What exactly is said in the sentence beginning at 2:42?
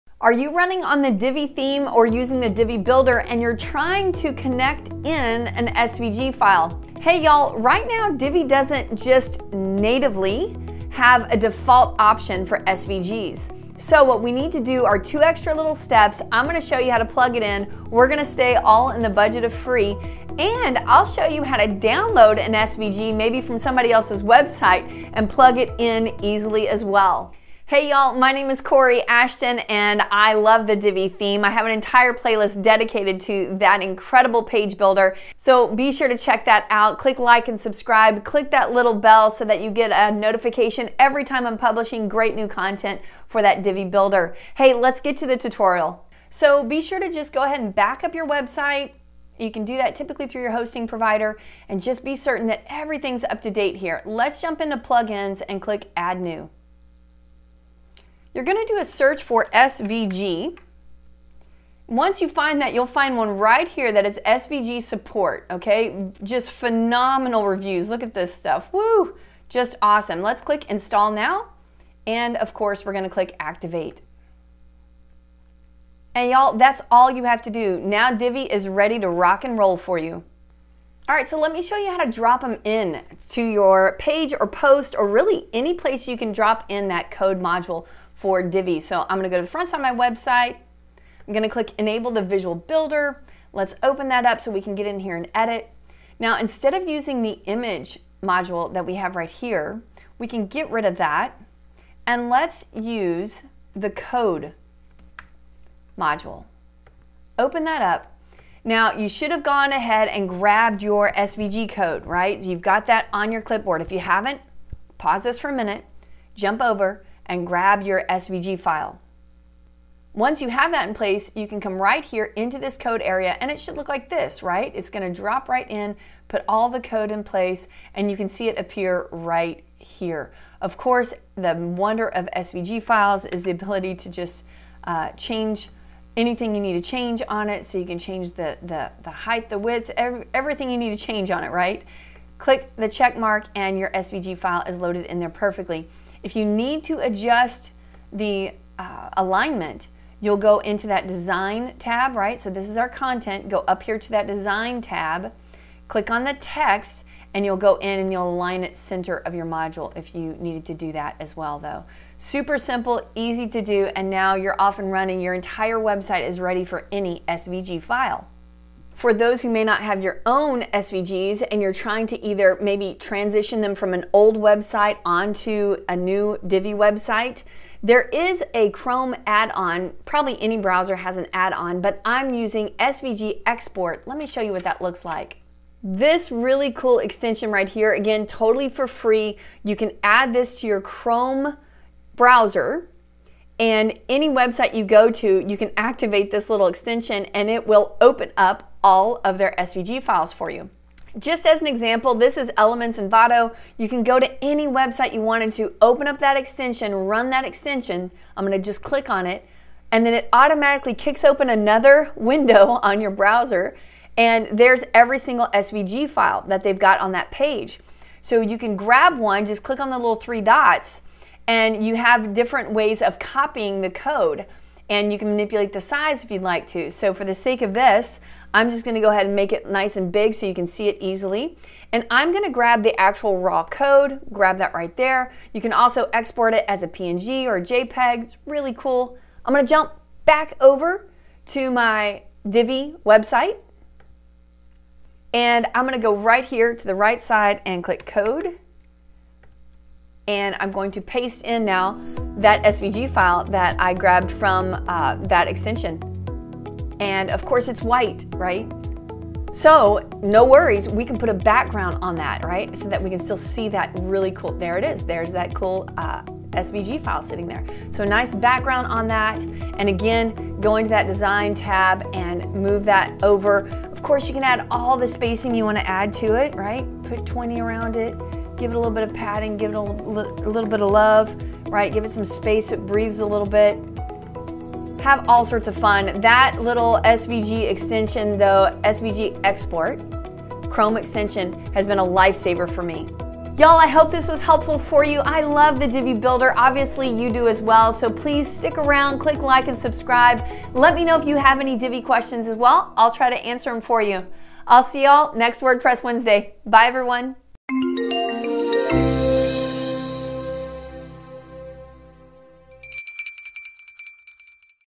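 Super simple, easy to do, and now you're off and running.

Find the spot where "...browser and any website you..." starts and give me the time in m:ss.
3:12.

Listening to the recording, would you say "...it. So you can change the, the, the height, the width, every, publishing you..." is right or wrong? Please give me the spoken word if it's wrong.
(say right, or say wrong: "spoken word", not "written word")
wrong: "everything", not "publishing".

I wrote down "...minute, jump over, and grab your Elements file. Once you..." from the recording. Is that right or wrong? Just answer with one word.
wrong.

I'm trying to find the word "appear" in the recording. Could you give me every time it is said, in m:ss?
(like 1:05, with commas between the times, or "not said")
2:08.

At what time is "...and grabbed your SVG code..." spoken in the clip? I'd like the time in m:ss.
1:50.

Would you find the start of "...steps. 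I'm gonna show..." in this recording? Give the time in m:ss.
0:15.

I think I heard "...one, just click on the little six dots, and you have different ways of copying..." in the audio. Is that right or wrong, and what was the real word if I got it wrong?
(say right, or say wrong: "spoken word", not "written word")
wrong: "three", not "six".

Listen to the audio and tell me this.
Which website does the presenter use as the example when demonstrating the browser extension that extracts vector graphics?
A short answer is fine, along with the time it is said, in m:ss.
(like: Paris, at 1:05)
Elements Envato, at 3:22.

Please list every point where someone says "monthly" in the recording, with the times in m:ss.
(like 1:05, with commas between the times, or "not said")
not said.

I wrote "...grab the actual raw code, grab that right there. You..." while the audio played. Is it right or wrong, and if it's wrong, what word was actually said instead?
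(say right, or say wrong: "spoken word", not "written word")
right.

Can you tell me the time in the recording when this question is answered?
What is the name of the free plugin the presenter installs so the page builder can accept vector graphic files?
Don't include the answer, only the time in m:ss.
1:04.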